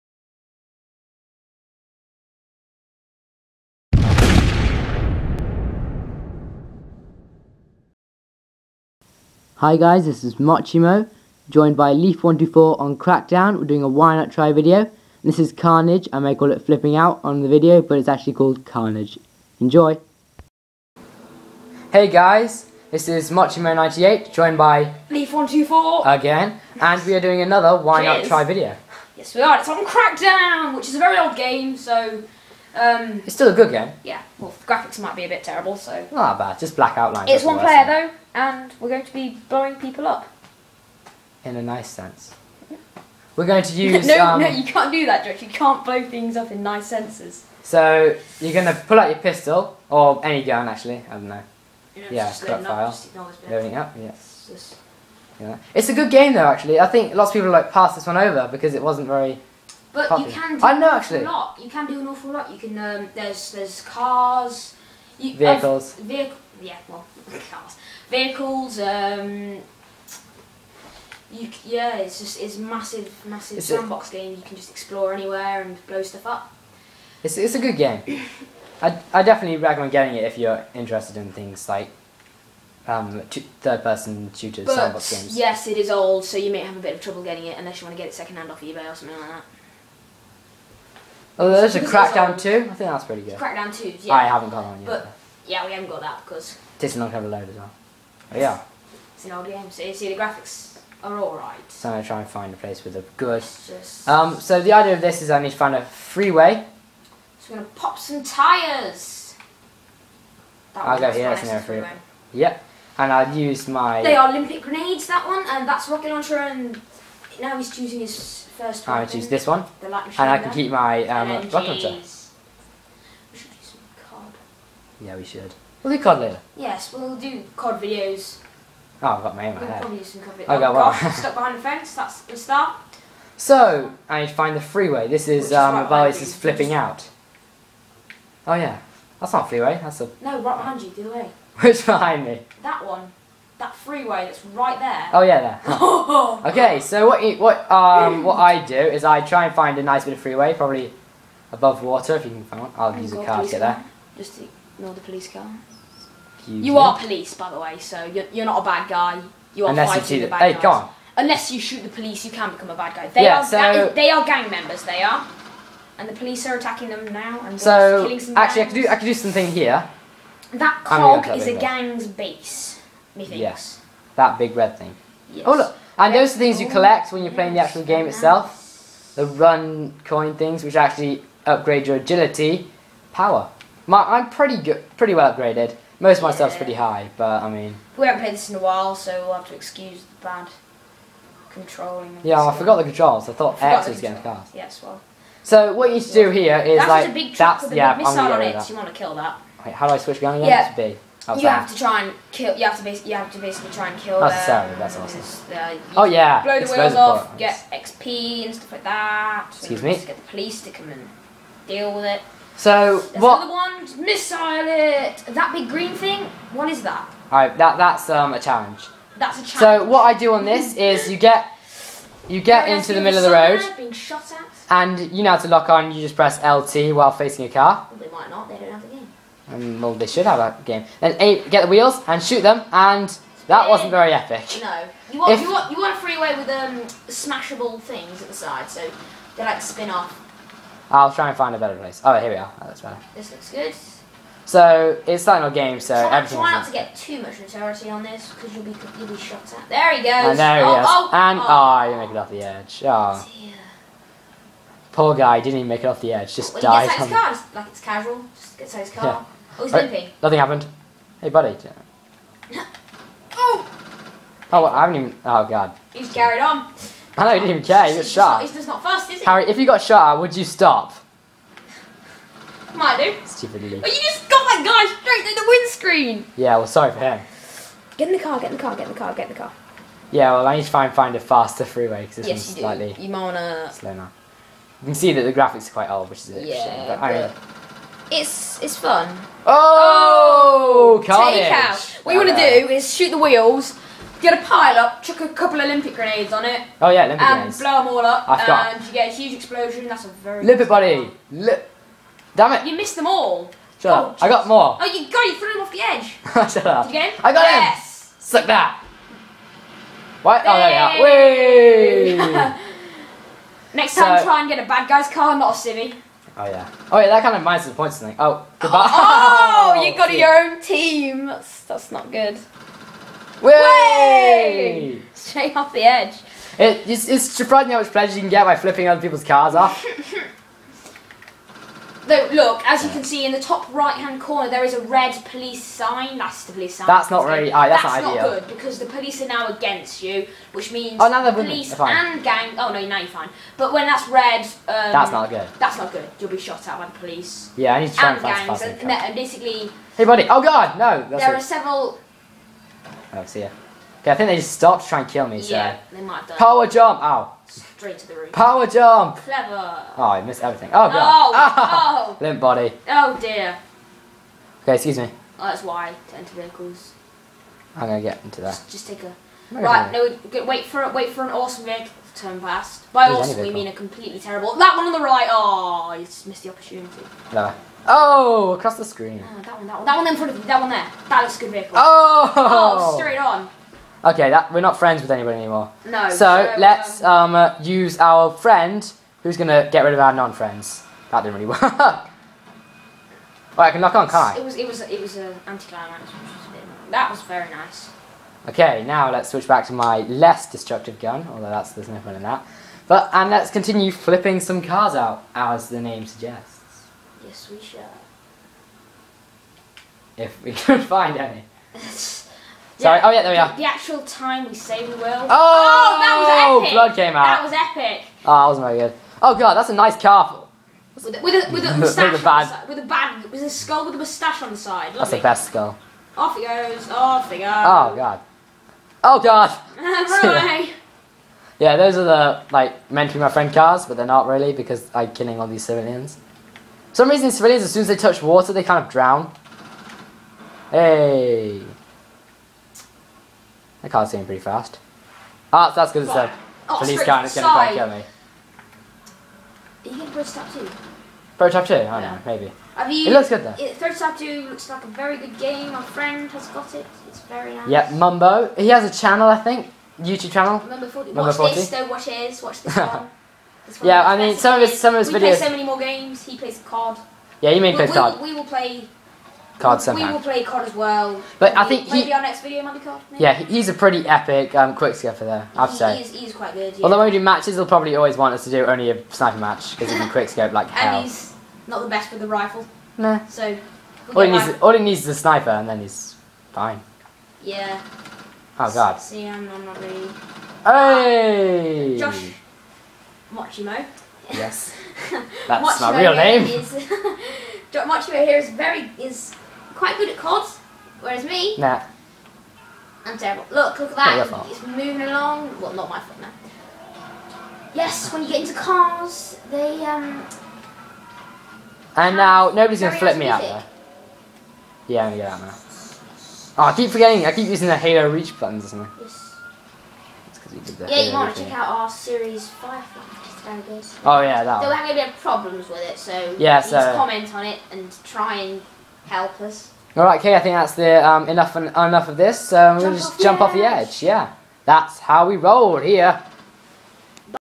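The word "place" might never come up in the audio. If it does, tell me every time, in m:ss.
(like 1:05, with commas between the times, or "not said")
1:42, 4:01.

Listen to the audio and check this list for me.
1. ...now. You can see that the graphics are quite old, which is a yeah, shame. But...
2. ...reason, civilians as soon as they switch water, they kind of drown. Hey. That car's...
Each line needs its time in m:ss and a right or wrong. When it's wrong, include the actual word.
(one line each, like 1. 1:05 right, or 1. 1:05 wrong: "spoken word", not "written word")
1. 4:43 right
2. 7:17 wrong: "touch", not "switch".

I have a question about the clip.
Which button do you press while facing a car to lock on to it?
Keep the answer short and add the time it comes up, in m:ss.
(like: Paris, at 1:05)
LT, at 3:46.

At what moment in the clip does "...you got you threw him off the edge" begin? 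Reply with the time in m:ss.
5:04.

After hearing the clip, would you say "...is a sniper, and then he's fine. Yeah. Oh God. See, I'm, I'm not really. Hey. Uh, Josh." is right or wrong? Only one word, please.
right.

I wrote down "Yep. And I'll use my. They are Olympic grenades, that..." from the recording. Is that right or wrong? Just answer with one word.
right.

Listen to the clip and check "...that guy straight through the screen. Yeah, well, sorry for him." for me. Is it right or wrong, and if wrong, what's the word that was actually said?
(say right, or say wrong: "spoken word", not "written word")
wrong: "windscreen", not "screen".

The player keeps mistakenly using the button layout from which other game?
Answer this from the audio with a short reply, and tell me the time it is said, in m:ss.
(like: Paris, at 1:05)
Halo Reach, at 8:37.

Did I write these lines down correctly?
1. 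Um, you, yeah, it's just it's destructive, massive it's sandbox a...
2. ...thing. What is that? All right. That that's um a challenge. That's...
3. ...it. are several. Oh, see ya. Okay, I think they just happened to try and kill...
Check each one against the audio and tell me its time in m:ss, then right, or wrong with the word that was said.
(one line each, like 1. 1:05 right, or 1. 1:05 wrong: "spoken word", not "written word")
1. 1:08 wrong: "massive", not "destructive"
2. 3:35 right
3. 5:51 wrong: "stopped", not "happened".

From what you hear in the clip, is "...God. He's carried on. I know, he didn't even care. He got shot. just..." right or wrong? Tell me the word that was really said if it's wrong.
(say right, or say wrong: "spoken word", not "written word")
right.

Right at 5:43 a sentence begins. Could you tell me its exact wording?
But when that's red, um, that's not good.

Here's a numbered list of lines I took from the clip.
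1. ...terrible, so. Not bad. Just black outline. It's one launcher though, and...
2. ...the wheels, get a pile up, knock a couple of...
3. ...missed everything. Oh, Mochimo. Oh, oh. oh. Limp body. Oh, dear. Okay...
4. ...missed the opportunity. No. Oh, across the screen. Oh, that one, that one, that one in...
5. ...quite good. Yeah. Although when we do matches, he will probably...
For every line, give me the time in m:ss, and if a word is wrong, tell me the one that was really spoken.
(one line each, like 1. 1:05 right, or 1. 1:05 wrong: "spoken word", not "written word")
1. 0:35 wrong: "player", not "launcher"
2. 4:53 wrong: "chuck", not "knock"
3. 6:00 wrong: "God", not "Mochimo"
4. 6:16 right
5. 7:56 right.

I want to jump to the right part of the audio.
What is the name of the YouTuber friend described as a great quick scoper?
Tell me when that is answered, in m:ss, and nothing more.
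7:40.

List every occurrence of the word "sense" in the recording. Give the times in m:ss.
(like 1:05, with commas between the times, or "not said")
0:41, 0:46.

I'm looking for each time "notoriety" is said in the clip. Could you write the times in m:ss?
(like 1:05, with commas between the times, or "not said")
4:07.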